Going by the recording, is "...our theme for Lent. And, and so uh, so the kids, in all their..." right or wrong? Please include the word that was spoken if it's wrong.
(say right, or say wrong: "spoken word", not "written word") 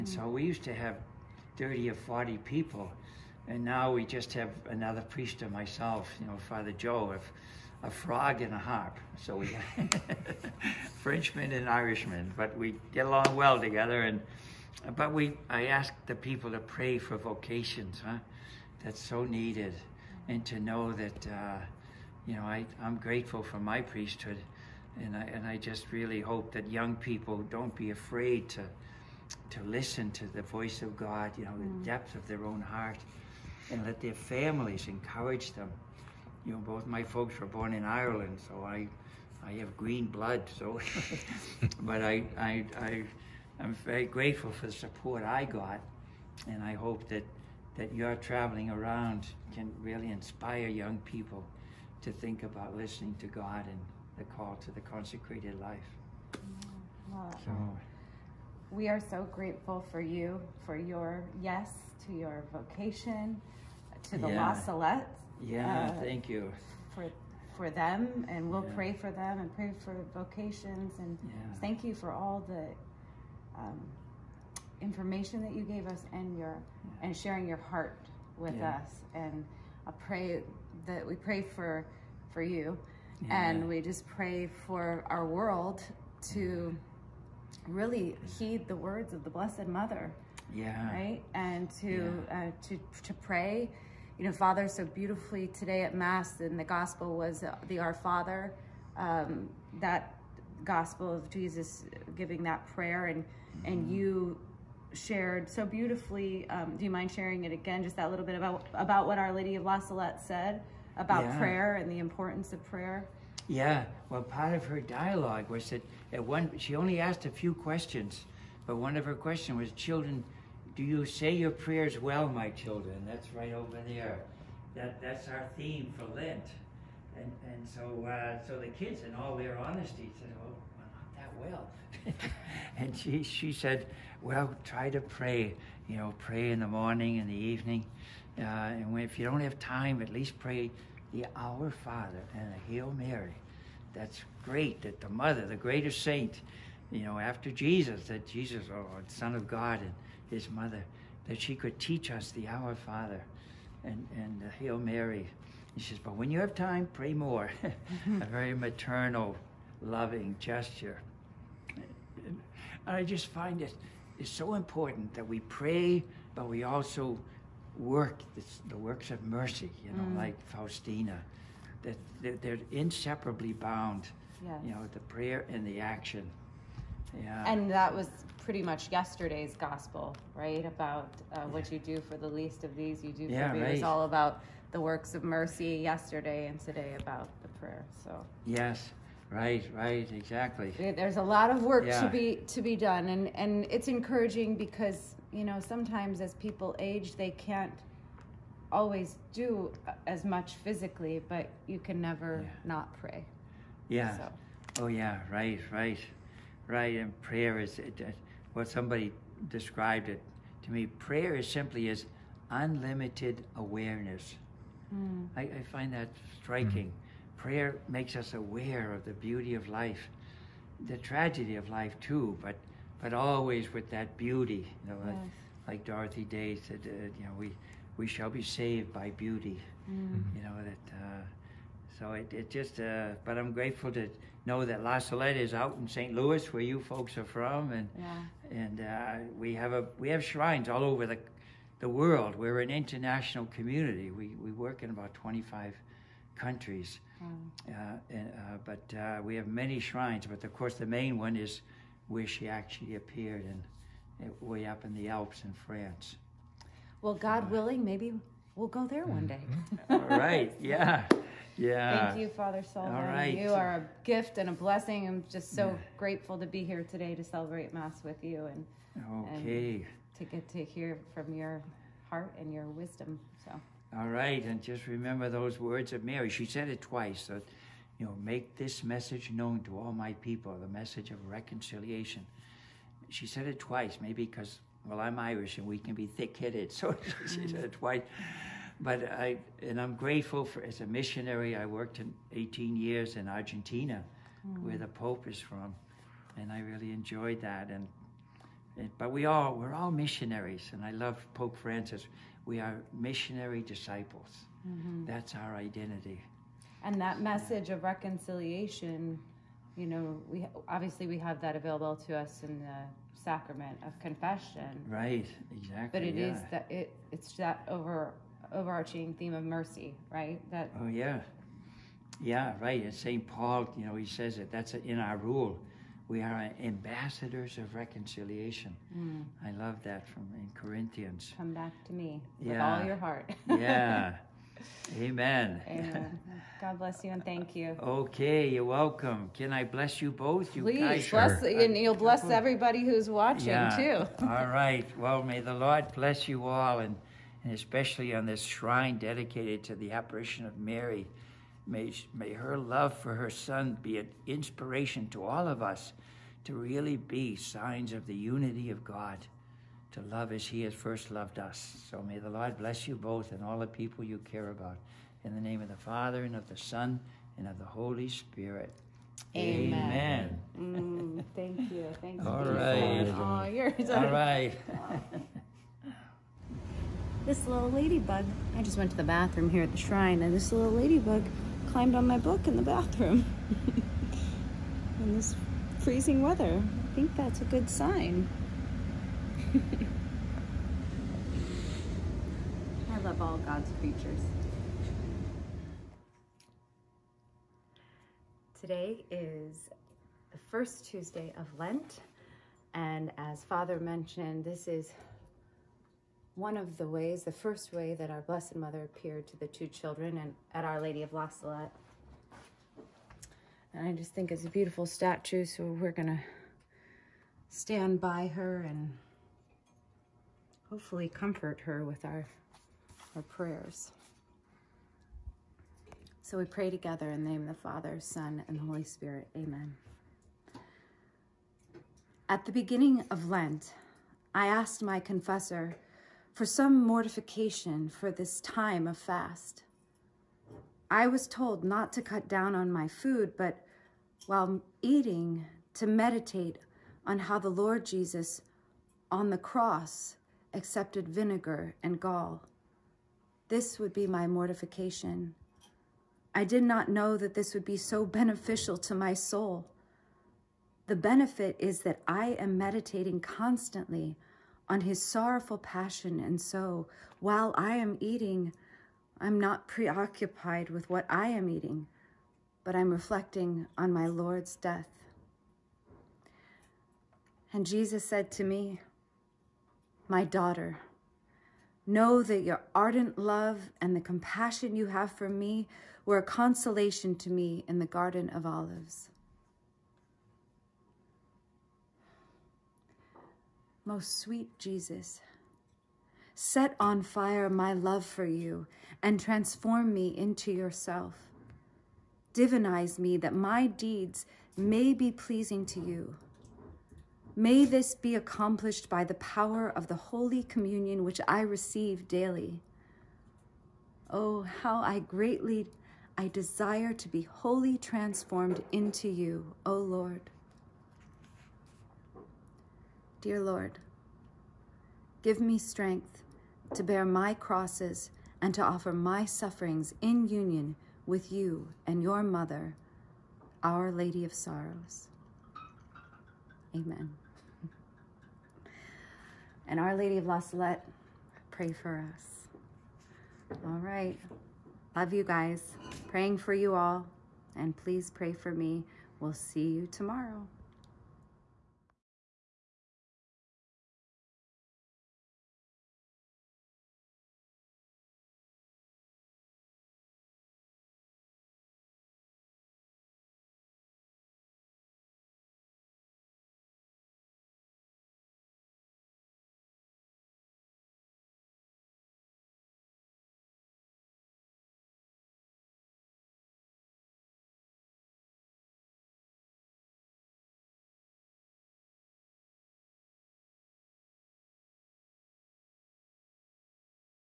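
right.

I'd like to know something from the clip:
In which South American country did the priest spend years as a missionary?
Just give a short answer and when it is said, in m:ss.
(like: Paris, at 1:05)
Argentina, at 4:53.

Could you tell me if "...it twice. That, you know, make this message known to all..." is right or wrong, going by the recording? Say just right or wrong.
right.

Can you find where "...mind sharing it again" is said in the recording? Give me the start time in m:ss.
1:46.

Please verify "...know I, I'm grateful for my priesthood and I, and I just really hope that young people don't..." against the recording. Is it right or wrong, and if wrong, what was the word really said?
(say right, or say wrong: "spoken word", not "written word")
right.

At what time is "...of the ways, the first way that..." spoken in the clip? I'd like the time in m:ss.
6:46.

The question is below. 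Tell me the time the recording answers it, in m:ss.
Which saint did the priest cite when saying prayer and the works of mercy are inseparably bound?
2:50.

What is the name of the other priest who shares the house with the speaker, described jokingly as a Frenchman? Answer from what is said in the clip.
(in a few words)
Father Joe.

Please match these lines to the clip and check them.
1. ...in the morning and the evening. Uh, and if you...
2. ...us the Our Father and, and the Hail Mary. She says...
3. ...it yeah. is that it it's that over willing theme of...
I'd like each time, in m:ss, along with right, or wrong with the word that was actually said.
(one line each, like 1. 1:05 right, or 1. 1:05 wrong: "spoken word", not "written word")
1. 2:16 right
2. 2:32 right
3. 5:16 wrong: "overarching", not "willing".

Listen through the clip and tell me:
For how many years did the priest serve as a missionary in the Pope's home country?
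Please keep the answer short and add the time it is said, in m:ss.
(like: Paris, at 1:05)
18, at 4:52.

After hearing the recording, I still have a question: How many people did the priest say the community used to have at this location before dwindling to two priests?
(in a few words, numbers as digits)
30 or 40.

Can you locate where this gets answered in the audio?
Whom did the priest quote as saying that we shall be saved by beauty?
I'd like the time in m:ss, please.
3:45.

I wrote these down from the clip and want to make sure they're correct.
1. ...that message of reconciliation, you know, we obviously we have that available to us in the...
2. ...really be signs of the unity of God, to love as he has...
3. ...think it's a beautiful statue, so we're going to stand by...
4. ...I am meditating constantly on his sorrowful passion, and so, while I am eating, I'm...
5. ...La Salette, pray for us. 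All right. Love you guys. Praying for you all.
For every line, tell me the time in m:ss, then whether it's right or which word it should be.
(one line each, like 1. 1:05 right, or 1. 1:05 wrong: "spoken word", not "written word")
1. 5:07 right
2. 5:56 right
3. 6:54 right
4. 7:42 right
5. 9:00 right.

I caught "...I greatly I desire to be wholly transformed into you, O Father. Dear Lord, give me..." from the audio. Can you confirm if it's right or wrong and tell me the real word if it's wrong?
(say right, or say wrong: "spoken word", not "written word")
wrong: "Lord", not "Father".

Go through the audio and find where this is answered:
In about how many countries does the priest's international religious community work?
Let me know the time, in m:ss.
4:05.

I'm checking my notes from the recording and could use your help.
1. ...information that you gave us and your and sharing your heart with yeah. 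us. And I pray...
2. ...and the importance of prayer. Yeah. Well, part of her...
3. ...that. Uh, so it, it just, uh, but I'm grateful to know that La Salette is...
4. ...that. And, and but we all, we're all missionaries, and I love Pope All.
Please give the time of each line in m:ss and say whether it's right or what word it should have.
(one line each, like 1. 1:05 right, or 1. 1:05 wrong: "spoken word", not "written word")
1. 1:14 right
2. 1:51 right
3. 3:50 right
4. 4:57 wrong: "Francis", not "All".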